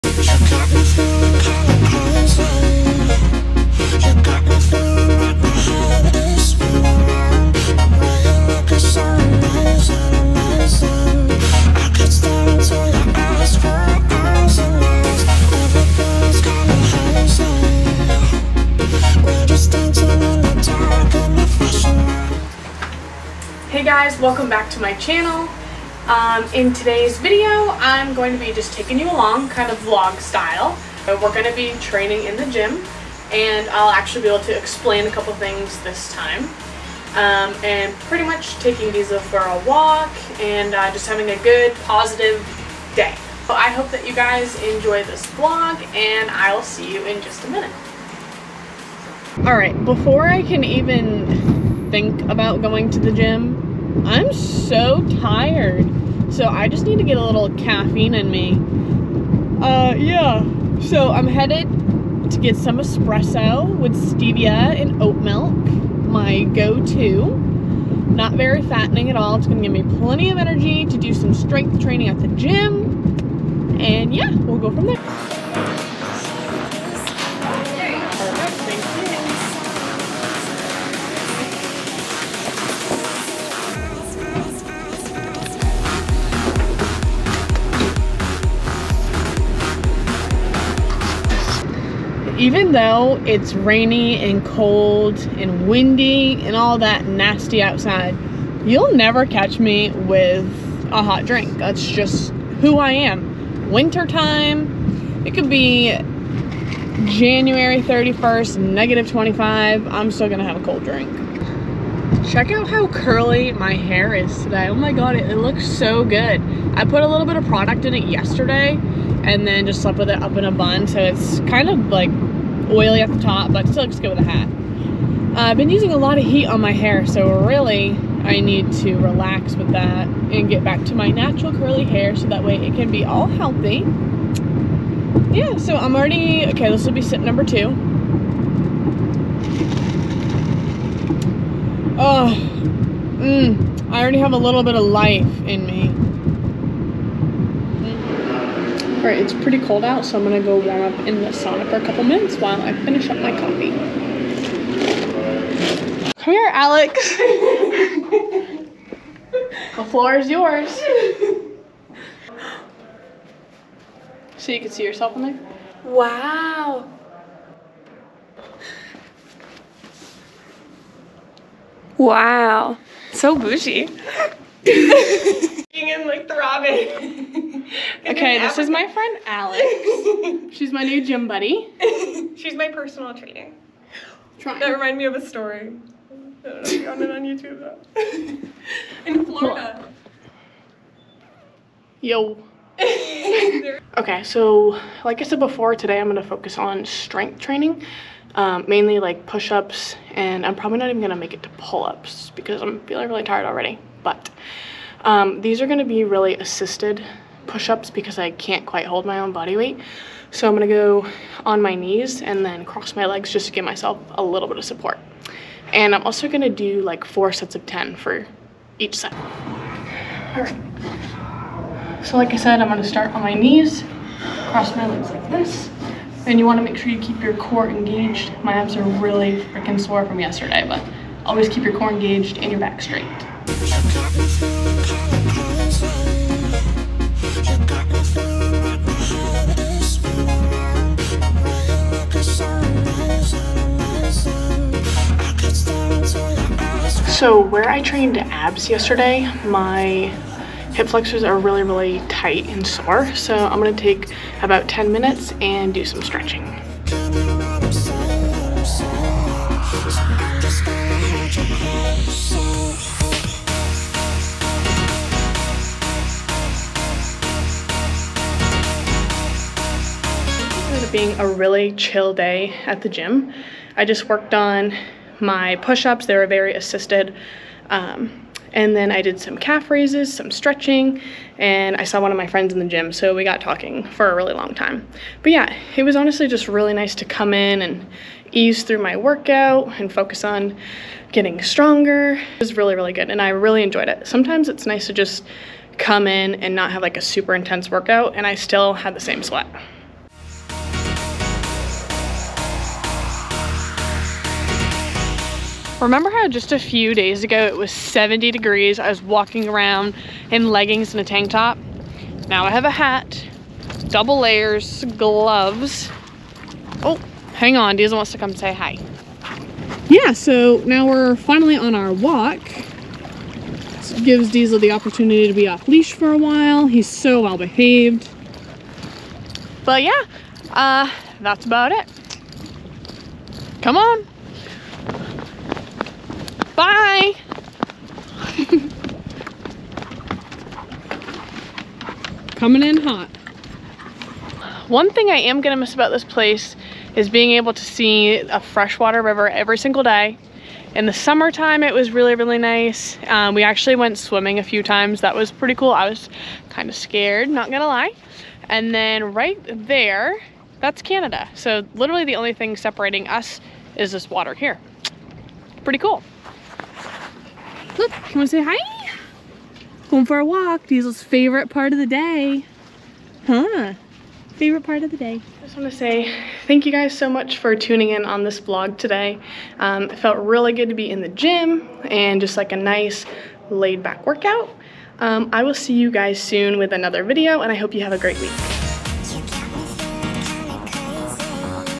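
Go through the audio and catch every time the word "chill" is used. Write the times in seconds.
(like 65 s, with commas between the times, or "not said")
271 s.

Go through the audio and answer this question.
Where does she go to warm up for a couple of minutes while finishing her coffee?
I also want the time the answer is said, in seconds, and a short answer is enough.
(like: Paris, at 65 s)
The sauna, at 151 s.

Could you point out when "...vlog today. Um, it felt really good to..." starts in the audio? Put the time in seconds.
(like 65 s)
378 s.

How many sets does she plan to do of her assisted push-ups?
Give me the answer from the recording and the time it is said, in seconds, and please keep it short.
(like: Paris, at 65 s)
4, at 217 s.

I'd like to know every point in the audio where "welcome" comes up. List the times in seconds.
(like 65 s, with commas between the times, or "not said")
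24 s.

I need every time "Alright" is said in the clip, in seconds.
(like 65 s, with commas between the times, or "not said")
49 s, 149 s.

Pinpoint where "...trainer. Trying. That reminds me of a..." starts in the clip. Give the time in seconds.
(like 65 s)
183 s.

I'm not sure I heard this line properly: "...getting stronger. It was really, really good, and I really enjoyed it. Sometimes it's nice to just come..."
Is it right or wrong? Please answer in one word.
right.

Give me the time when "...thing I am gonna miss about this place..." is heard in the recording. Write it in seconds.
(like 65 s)
344 s.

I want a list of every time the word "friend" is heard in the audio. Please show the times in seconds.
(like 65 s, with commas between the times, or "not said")
178 s, 282 s.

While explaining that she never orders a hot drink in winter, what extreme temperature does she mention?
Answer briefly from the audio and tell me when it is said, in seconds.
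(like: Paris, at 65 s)
-25, at 108 s.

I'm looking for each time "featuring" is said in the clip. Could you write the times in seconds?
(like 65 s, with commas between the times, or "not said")
not said.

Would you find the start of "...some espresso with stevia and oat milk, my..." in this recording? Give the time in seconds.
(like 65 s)
62 s.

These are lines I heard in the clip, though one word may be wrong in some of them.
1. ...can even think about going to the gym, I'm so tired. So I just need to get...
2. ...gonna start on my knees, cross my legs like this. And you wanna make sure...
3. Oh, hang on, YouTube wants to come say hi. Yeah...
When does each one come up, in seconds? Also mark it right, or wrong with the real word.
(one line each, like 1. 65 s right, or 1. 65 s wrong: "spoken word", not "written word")
1. 50 s right
2. 222 s right
3. 316 s wrong: "Diesel", not "YouTube".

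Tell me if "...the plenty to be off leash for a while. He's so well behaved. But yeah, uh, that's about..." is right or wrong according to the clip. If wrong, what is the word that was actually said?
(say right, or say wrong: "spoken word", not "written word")
wrong: "opportunity", not "plenty".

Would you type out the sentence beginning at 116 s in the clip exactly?
I put a little bit of product in it yesterday and then just slept with it up in a bun.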